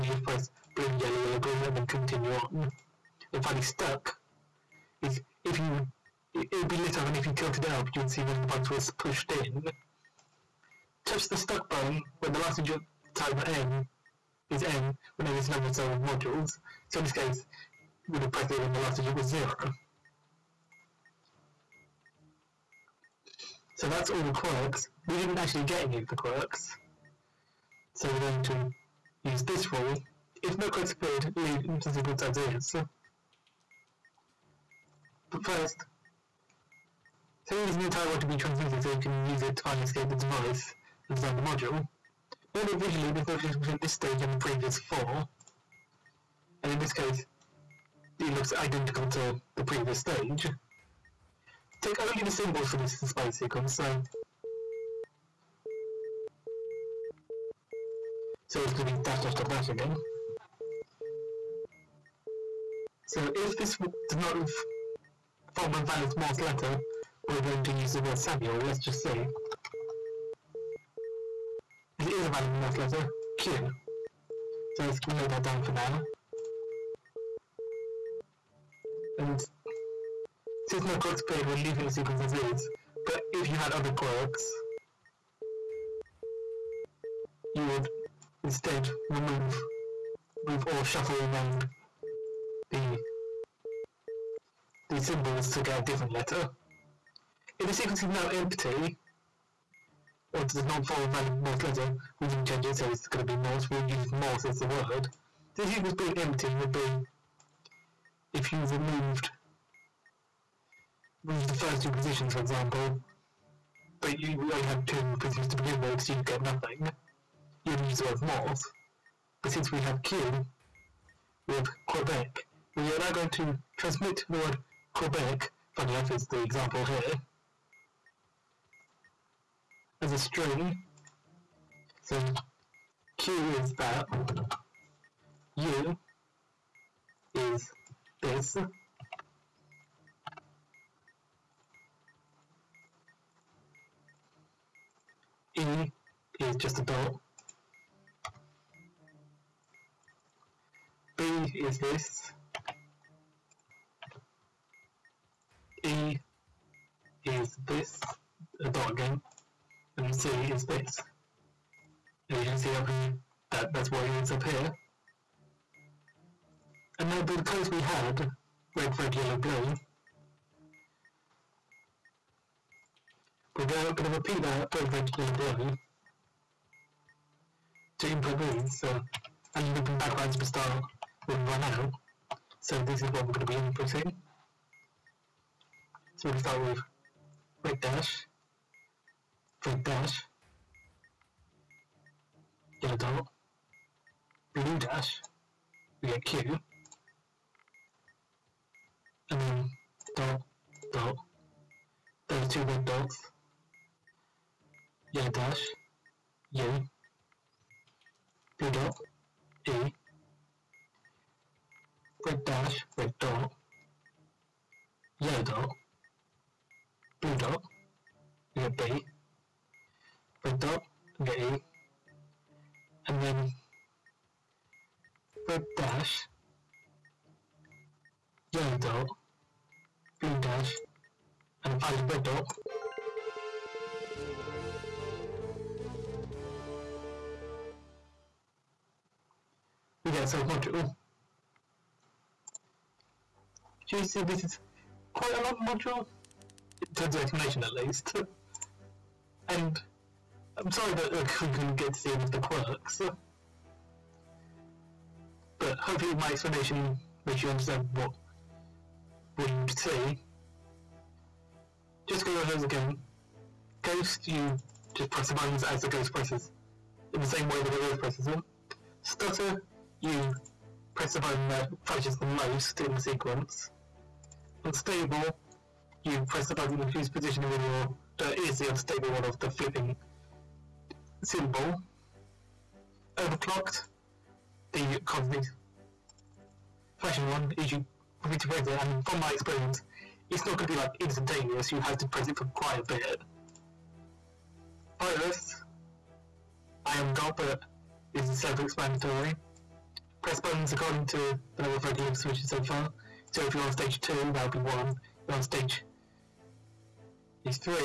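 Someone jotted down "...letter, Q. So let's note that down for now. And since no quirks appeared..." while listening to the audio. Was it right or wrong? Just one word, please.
right.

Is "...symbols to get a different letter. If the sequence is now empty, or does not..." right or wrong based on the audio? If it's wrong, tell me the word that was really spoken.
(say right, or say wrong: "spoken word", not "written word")
right.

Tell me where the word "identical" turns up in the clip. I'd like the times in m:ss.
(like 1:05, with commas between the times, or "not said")
0:48.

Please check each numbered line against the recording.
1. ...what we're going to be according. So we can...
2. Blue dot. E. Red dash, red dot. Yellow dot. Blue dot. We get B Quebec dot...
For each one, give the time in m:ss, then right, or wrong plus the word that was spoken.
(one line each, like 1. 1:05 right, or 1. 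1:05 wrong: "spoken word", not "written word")
1. 3:03 wrong: "inputting", not "according"
2. 3:28 wrong: "Red", not "Quebec".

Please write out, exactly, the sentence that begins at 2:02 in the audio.
We are now going to transmit the word Quebec, funny enough, is the example here, as a string.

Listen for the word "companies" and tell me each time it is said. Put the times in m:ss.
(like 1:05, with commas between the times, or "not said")
not said.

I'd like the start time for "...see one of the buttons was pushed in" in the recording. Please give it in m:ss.
0:08.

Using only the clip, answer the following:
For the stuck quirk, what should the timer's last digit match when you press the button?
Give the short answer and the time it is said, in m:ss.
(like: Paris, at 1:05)
the number of cell modules, at 0:15.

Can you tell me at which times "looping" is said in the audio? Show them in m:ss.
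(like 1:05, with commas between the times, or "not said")
2:59.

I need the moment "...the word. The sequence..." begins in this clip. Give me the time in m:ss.
1:44.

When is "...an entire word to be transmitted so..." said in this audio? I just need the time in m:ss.
0:37.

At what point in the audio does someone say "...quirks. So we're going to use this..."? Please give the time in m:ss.
0:26.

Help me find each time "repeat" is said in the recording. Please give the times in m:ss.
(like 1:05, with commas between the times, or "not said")
2:54.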